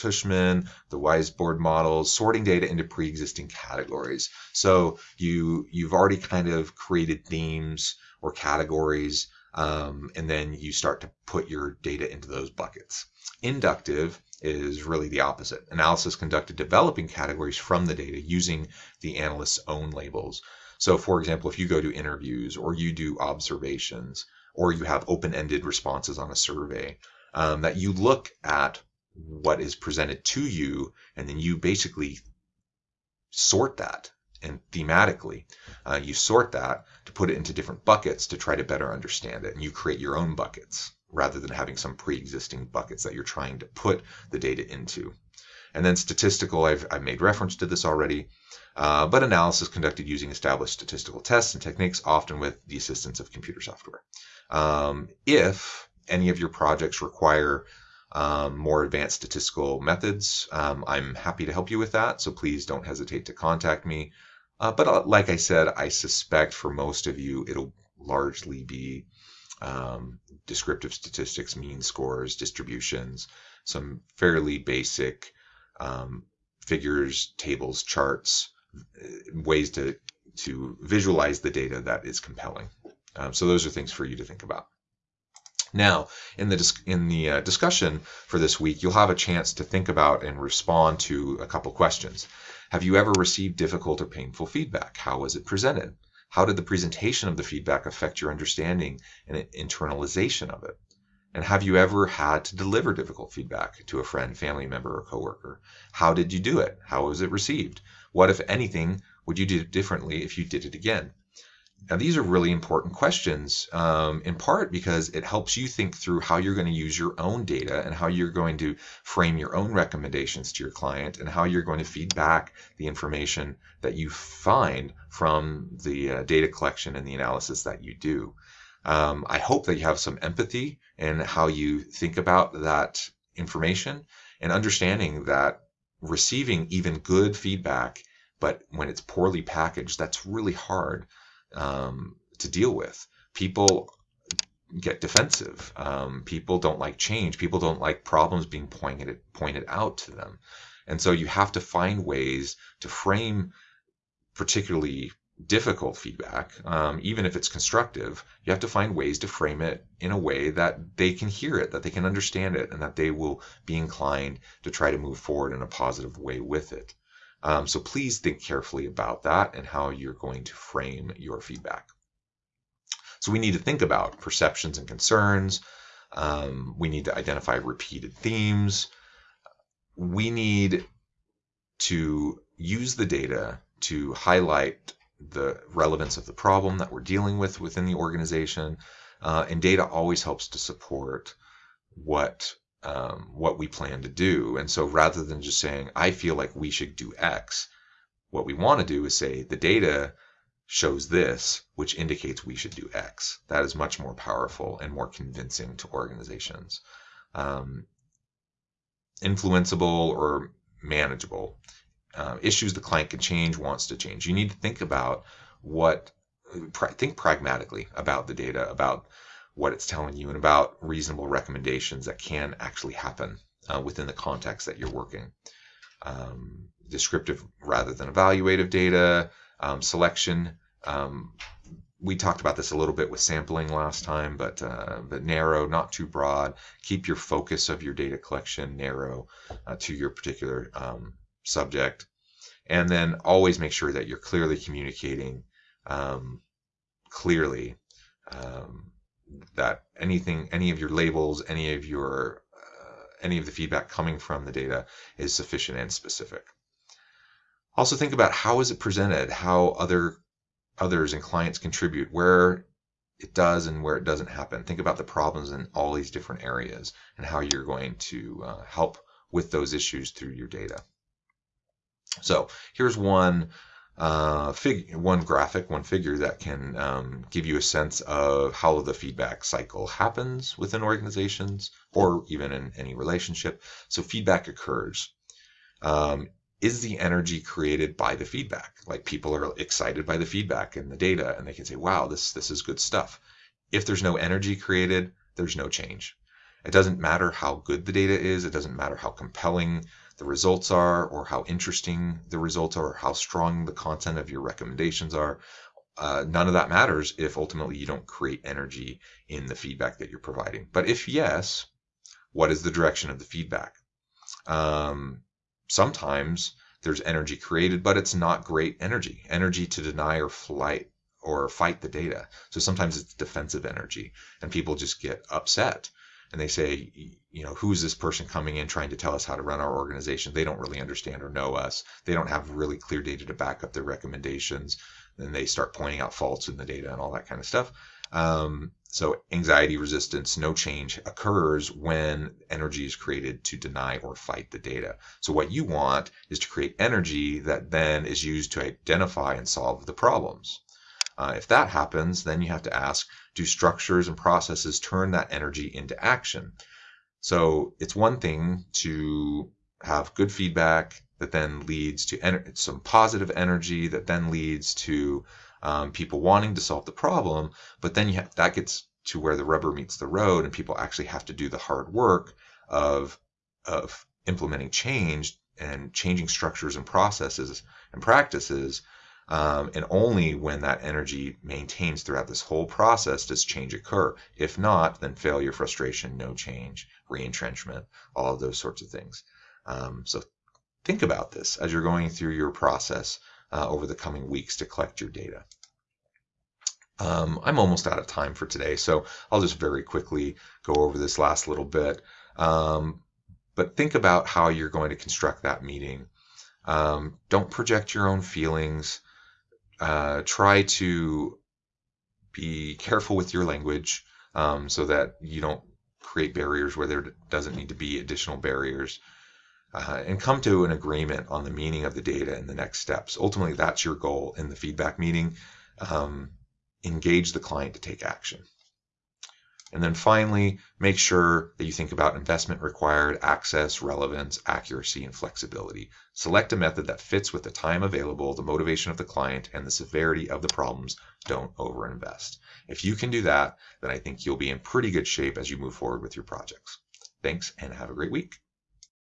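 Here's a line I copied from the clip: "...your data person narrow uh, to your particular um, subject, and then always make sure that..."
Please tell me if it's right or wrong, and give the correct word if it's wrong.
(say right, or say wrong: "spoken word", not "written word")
wrong: "collection", not "person".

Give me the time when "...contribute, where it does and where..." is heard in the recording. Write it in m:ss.
4:21.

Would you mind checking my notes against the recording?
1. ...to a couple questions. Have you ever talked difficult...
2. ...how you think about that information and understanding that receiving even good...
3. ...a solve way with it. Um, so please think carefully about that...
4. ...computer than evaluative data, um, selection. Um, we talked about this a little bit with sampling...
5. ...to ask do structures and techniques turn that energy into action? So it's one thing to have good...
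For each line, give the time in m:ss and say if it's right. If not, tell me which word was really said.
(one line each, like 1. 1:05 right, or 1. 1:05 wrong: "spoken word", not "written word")
1. 1:31 wrong: "received", not "talked"
2. 2:11 right
3. 2:45 wrong: "positive", not "solve"
4. 3:47 wrong: "rather", not "computer"
5. 5:52 wrong: "processes", not "techniques".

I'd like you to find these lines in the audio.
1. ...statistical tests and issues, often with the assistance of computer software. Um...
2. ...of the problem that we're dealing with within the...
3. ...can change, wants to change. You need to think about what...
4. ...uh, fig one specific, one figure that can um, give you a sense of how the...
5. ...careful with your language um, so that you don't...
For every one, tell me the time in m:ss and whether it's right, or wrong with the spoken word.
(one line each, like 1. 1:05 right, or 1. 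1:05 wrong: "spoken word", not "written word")
1. 0:50 wrong: "techniques", not "issues"
2. 3:06 right
3. 3:33 right
4. 4:33 wrong: "graphic", not "specific"
5. 6:52 right.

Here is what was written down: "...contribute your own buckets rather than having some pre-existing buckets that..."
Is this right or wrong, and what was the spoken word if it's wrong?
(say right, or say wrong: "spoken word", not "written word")
wrong: "create", not "contribute".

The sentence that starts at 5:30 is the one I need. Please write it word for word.
They don't really understand or know us.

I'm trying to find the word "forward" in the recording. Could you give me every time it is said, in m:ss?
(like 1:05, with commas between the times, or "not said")
2:45, 7:25.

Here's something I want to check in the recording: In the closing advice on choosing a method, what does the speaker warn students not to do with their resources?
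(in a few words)
overinvest.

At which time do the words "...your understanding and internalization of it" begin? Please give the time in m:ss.
1:38.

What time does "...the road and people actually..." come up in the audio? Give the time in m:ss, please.
6:09.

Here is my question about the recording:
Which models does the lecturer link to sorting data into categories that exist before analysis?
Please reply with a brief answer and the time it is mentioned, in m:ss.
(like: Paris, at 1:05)
Weisbord models, at 0:00.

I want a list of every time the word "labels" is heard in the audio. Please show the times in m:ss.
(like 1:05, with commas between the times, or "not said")
0:19, 4:10.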